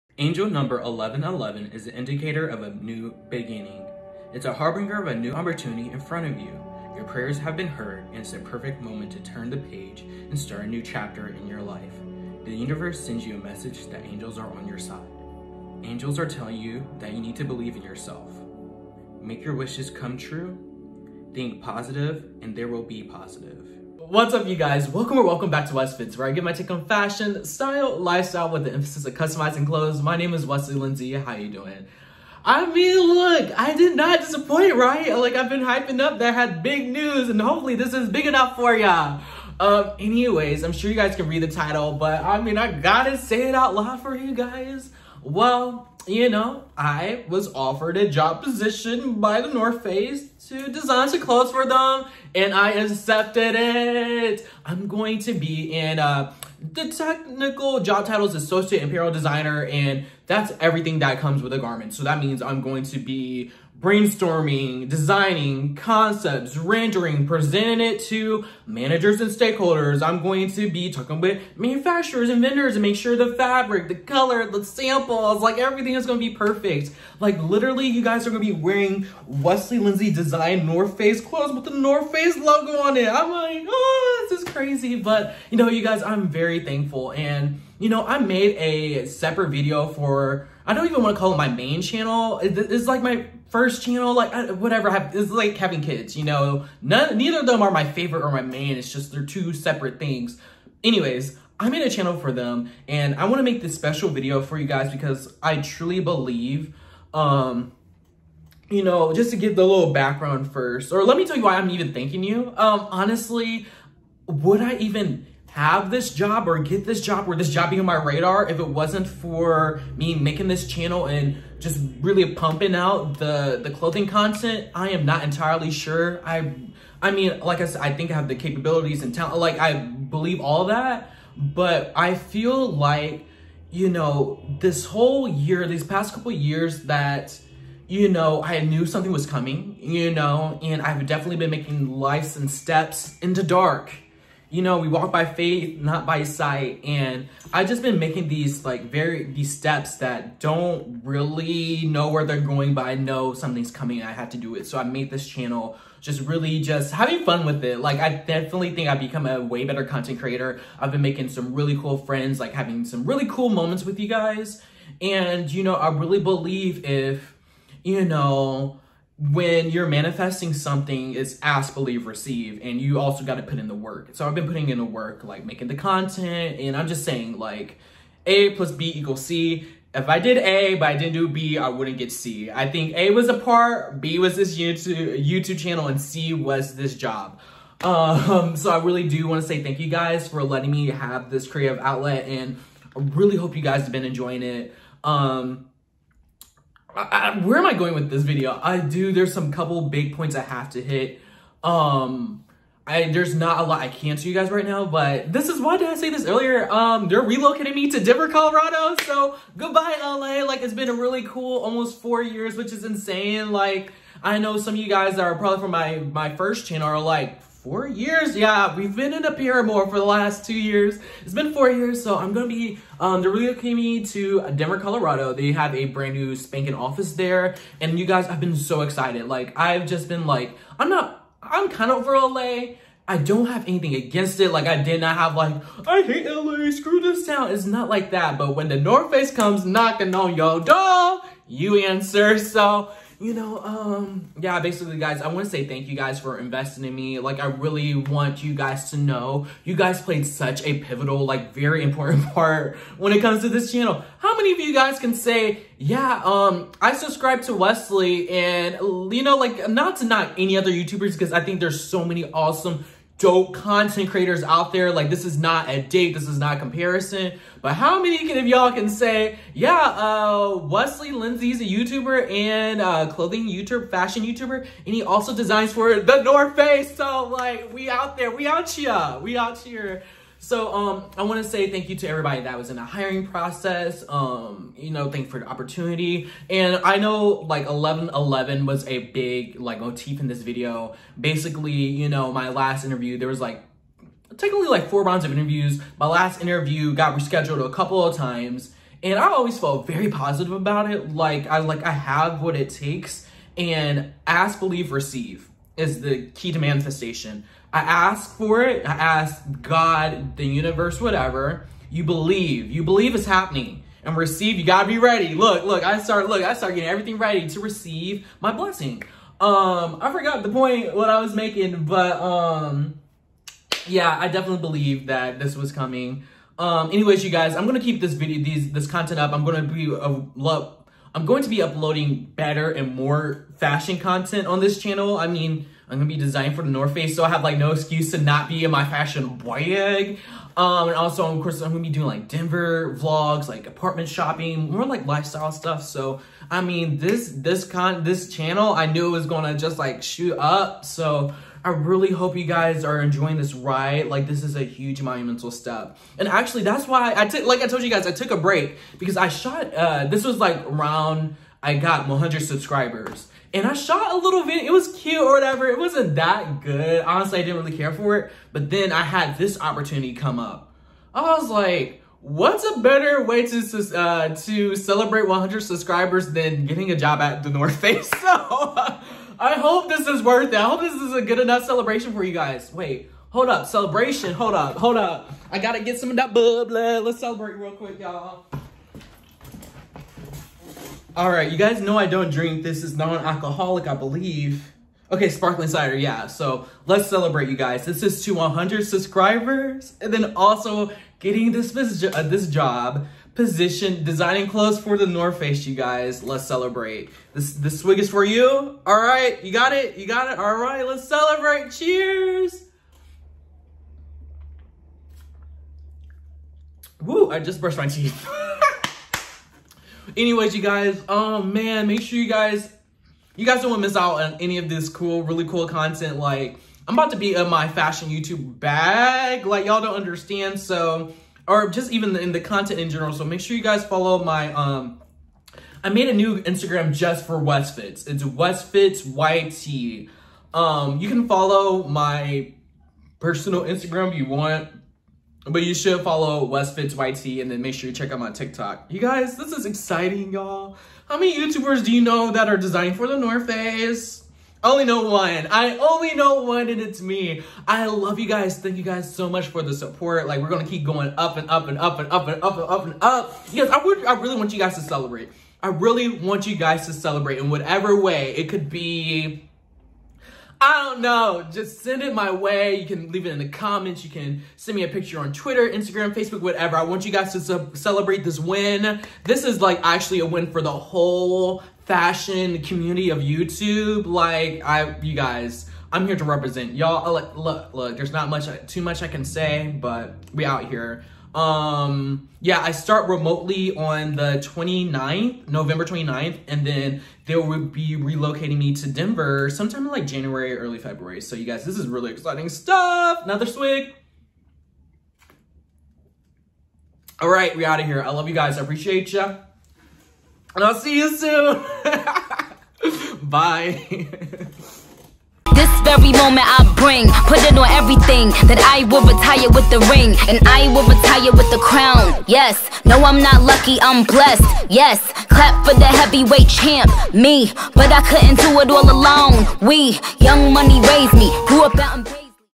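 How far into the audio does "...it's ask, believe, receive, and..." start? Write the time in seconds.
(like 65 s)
171 s.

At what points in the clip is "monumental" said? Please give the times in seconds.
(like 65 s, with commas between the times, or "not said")
355 s.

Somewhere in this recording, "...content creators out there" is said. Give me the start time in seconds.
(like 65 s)
263 s.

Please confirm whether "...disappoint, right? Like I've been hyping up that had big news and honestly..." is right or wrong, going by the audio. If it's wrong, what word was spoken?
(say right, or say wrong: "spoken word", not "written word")
wrong: "hopefully", not "honestly".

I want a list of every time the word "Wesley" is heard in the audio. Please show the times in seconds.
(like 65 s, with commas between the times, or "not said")
30 s, 79 s, 257 s, 270 s.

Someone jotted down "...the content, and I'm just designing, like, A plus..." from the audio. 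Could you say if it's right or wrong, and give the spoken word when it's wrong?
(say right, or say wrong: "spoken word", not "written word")
wrong: "saying", not "designing".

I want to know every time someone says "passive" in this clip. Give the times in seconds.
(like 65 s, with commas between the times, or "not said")
not said.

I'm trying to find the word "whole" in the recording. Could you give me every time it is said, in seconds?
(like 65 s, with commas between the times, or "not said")
134 s, 480 s.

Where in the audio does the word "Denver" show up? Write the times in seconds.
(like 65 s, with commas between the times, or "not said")
207 s, 224 s, 342 s, 498 s.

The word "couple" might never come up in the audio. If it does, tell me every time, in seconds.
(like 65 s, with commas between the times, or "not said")
136 s, 199 s, 297 s.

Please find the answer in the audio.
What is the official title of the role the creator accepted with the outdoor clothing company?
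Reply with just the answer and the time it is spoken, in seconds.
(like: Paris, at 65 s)
associate apparel designer, at 58 s.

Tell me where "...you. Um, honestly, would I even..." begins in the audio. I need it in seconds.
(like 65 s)
112 s.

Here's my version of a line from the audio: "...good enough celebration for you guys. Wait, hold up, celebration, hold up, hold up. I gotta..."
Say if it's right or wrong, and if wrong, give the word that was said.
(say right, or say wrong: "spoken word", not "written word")
right.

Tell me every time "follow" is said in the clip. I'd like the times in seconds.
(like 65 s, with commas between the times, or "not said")
433 s, 441 s, 446 s.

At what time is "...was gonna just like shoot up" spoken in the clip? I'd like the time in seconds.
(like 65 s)
349 s.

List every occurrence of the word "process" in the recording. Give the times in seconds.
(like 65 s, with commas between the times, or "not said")
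283 s.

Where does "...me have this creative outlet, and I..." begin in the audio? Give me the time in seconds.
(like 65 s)
190 s.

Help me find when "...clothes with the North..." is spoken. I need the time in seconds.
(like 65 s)
81 s.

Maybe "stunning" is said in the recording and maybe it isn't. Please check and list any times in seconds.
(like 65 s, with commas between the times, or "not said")
not said.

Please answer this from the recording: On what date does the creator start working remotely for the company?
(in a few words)
November 29th.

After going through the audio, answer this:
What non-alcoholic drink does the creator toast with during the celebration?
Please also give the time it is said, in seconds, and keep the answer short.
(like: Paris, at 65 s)
sparkling cider, at 395 s.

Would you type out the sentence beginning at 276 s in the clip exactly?
So like, we out there, we out here, we out here.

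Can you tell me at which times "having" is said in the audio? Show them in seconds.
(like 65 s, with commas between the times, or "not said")
95 s, 156 s, 162 s.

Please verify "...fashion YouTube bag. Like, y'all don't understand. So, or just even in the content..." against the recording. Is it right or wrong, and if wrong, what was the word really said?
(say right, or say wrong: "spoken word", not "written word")
right.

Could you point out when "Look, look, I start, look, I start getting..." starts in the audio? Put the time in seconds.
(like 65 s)
315 s.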